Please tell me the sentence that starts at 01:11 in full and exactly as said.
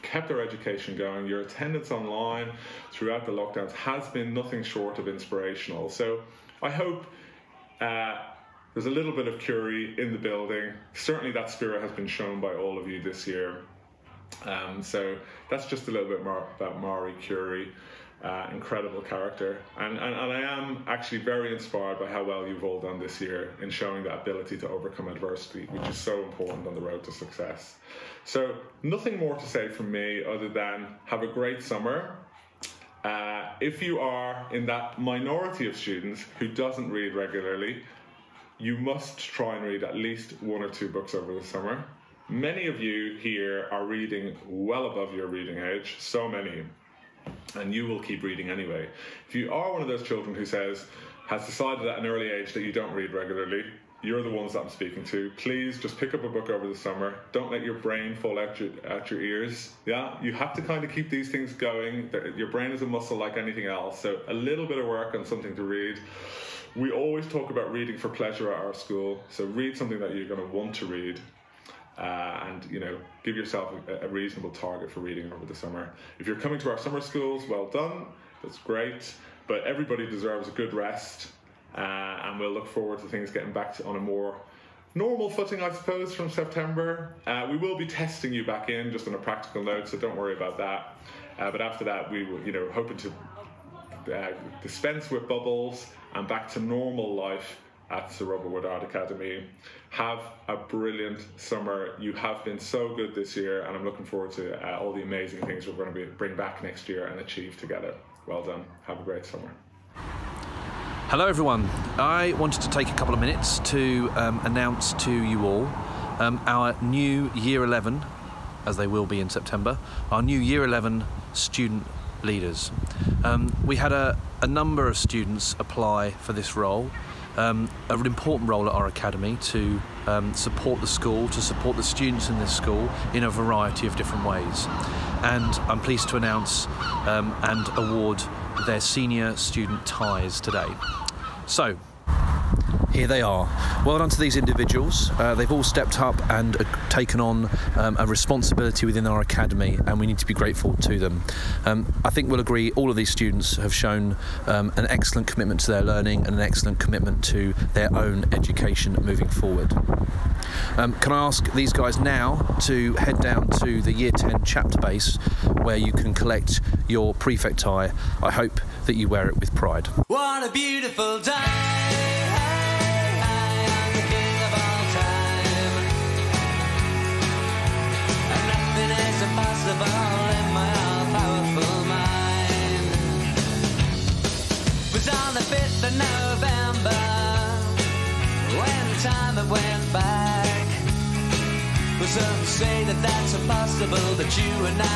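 Uh, and you know, give yourself a, a reasonable target for reading over the summer.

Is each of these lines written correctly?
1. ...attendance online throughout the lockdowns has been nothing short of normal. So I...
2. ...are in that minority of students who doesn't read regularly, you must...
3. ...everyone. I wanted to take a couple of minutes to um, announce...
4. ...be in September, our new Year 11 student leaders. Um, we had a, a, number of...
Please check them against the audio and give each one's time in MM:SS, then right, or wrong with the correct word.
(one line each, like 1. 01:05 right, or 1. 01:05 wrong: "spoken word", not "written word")
1. 00:01 wrong: "inspirational", not "normal"
2. 00:33 right
3. 01:51 right
4. 01:59 right.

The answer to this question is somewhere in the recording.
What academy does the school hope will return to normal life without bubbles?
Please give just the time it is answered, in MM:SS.
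01:38.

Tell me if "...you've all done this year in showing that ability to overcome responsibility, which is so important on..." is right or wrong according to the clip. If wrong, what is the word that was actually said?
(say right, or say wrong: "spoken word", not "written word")
wrong: "adversity", not "responsibility".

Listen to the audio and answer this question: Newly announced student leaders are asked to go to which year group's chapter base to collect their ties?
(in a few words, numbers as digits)
Year 10.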